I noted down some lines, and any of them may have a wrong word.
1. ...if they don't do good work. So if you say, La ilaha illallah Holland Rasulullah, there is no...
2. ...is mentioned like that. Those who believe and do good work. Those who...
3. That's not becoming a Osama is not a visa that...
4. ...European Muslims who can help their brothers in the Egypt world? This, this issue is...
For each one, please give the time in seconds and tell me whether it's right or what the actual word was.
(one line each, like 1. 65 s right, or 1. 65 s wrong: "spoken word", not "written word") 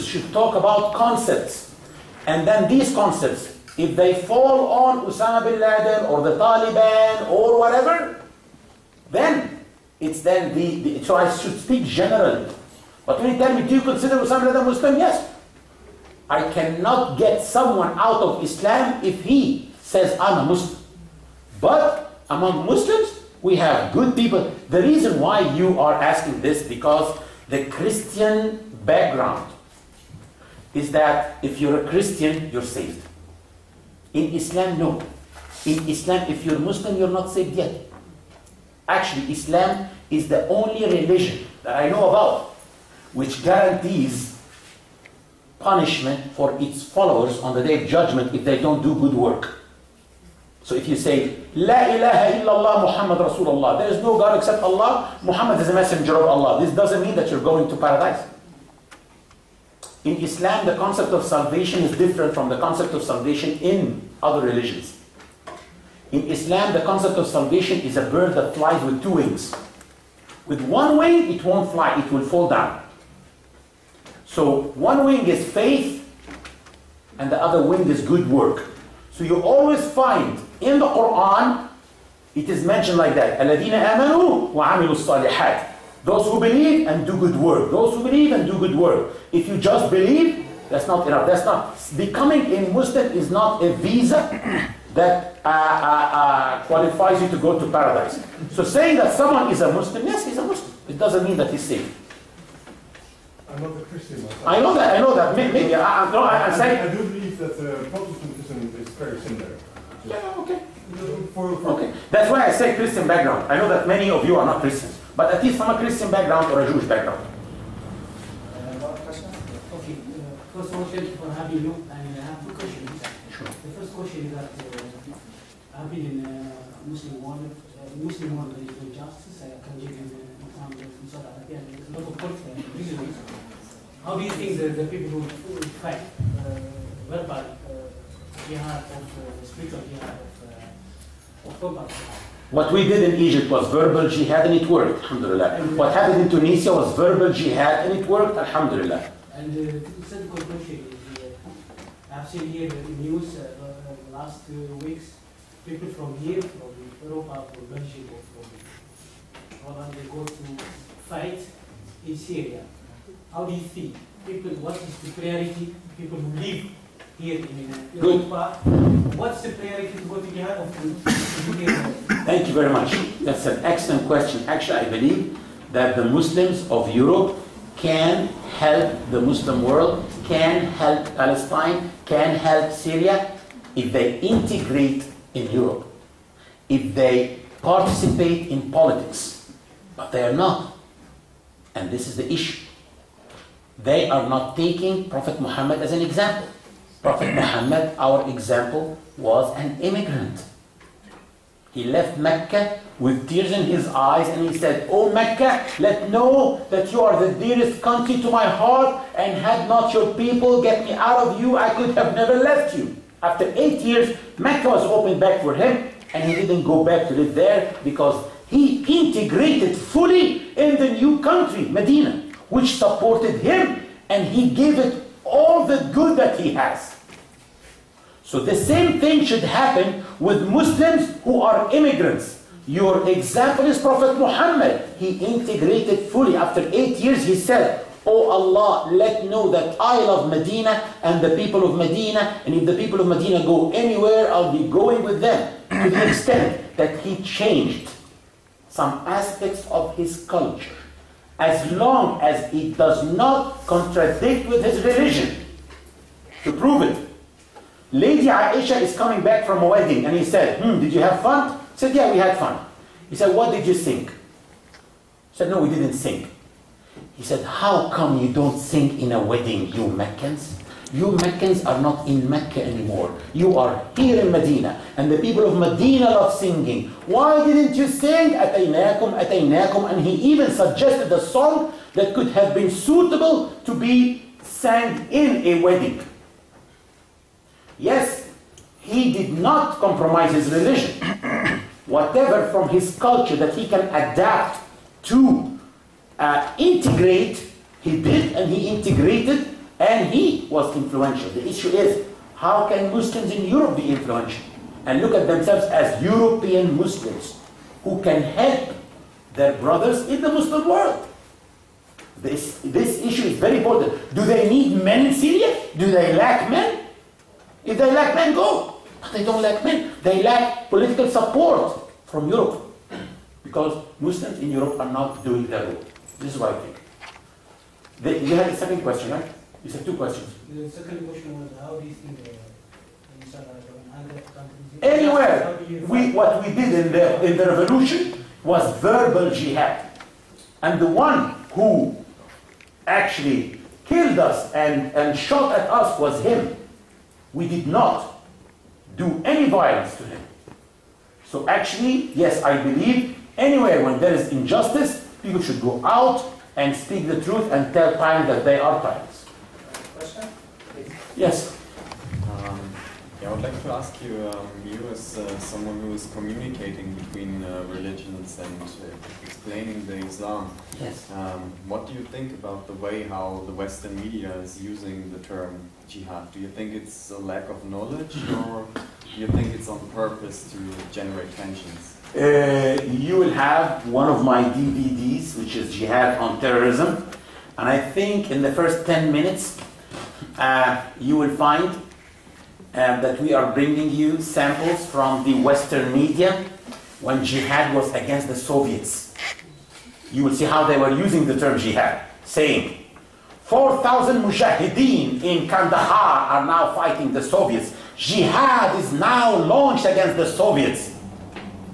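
1. 48 s wrong: "Muhammad", not "Holland"
2. 82 s right
3. 91 s wrong: "Muslim", not "Osama"
4. 306 s wrong: "Muslim", not "Egypt".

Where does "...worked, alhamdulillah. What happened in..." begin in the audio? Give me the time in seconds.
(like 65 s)
144 s.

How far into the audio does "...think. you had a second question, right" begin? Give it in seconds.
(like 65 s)
326 s.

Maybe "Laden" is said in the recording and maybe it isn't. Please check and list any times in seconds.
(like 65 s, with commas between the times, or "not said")
5 s, 14 s.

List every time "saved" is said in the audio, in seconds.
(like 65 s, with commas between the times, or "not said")
32 s, 37 s, 101 s.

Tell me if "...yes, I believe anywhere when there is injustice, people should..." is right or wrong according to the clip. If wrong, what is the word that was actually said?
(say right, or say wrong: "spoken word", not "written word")
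right.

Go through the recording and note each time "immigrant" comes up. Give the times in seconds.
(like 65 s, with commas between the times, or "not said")
199 s, 231 s.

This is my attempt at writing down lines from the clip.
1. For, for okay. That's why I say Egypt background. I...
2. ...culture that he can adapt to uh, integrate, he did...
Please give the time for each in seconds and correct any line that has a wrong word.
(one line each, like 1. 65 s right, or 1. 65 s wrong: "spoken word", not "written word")
1. 111 s wrong: "Christian", not "Egypt"
2. 292 s right.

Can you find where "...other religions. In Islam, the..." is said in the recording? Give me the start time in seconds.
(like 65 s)
64 s.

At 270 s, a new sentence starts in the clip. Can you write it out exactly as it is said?
You Meccans are not in Mecca anymore.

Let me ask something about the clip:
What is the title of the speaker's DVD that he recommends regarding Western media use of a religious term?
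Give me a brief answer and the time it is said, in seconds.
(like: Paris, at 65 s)
Jihad on Terrorism, at 385 s.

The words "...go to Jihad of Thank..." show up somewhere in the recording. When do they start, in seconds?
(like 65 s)
170 s.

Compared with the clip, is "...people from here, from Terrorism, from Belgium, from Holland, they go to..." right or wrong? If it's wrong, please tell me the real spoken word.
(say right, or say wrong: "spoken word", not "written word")
wrong: "Europe", not "Terrorism".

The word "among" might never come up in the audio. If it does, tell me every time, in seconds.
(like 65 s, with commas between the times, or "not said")
22 s.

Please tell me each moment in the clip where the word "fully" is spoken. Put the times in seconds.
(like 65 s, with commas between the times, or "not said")
219 s, 236 s.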